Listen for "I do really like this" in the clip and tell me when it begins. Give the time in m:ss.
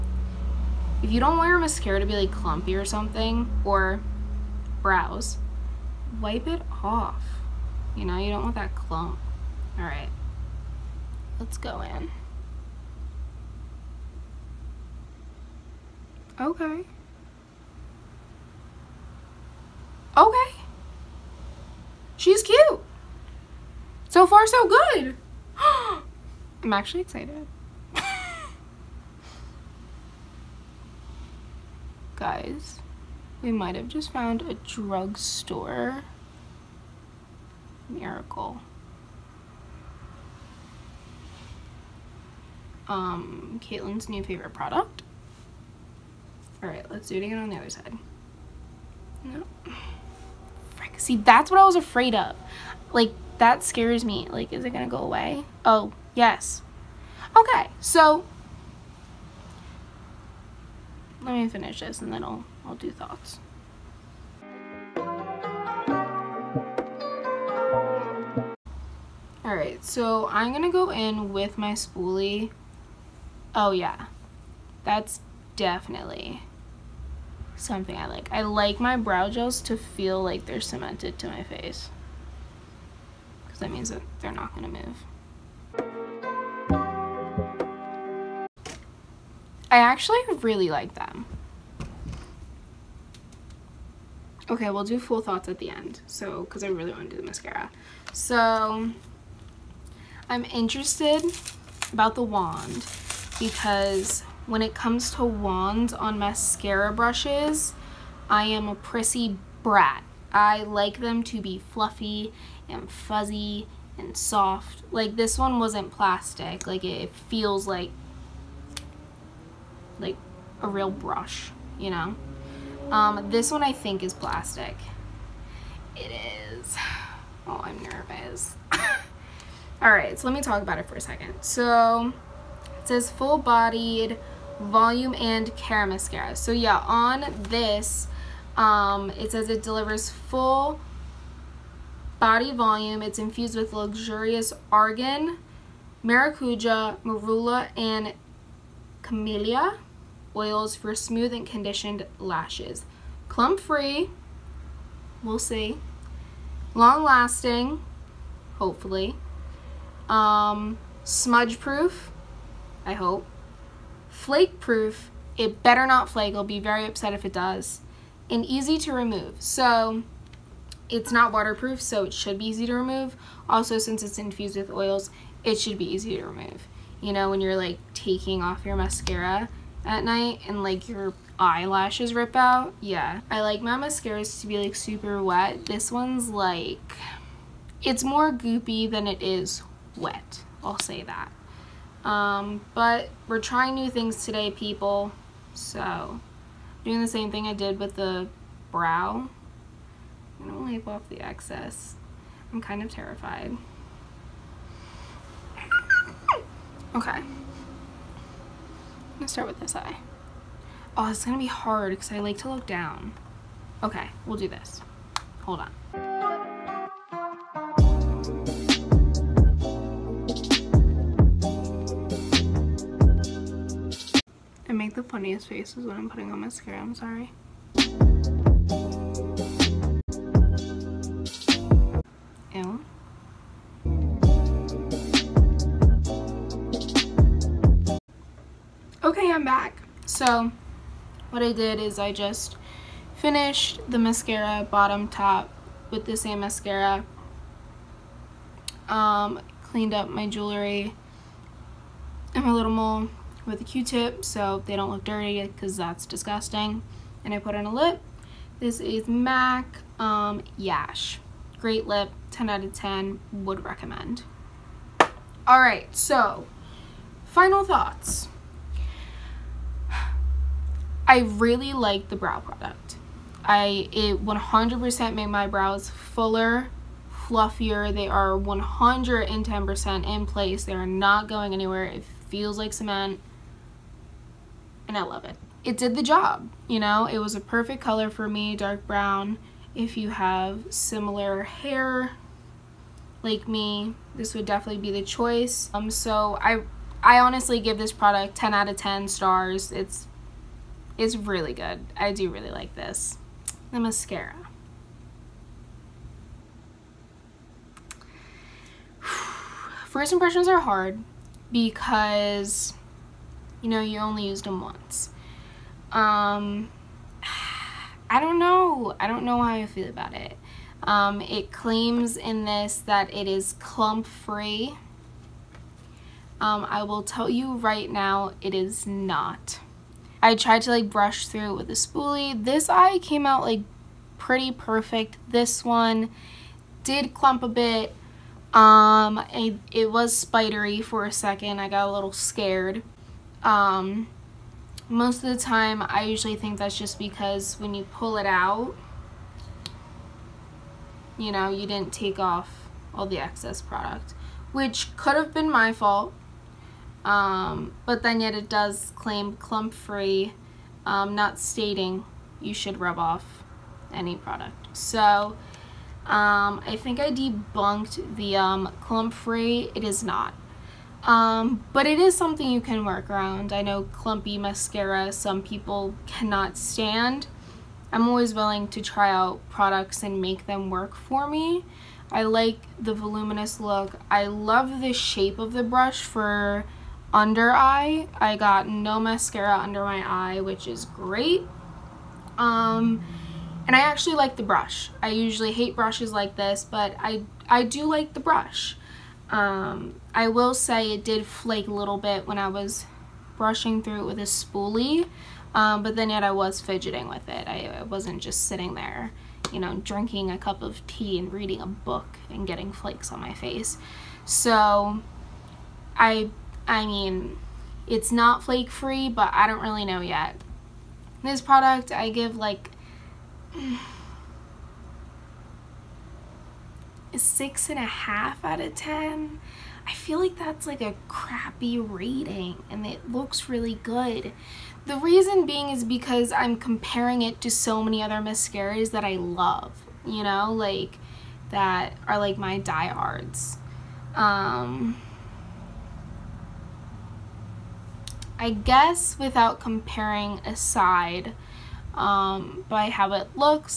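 5:01.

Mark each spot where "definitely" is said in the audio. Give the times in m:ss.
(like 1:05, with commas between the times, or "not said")
1:15, 4:54.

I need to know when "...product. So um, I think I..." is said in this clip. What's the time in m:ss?
6:04.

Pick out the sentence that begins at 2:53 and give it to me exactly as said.
Also, since it's infused with oils, it should be easy to remove.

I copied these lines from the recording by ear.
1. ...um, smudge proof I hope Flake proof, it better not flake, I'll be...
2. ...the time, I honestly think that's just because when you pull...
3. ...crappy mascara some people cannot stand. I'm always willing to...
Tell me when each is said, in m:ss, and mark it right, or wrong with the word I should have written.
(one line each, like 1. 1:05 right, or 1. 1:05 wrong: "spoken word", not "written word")
1. 2:40 right
2. 5:45 wrong: "usually", not "honestly"
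3. 6:13 wrong: "clumpy", not "crappy".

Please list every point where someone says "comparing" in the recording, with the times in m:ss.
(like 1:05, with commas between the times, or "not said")
7:16, 7:29.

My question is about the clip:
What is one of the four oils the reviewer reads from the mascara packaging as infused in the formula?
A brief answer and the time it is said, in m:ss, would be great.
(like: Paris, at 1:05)
Argan, at 2:24.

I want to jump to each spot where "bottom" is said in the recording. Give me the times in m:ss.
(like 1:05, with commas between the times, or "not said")
4:04.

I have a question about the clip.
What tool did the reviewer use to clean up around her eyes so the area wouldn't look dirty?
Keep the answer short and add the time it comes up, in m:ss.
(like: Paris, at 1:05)
Q-tip, at 4:13.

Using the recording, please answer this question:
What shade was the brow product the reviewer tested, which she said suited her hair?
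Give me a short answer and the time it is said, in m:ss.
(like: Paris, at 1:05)
Dark brown, at 4:48.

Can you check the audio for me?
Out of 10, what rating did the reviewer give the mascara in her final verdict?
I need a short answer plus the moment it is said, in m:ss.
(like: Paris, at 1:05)
6.5, at 7:07.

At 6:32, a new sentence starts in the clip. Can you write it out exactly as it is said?
Um, and I actually like the brush.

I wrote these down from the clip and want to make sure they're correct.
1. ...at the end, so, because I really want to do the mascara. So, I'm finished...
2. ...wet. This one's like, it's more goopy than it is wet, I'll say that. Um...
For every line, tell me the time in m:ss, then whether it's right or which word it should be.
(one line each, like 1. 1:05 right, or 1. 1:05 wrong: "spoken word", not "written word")
1. 1:35 wrong: "interested", not "finished"
2. 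3:05 right.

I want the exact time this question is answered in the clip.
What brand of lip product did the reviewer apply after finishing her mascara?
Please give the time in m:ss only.
4:19.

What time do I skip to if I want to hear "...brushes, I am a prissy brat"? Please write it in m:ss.
1:46.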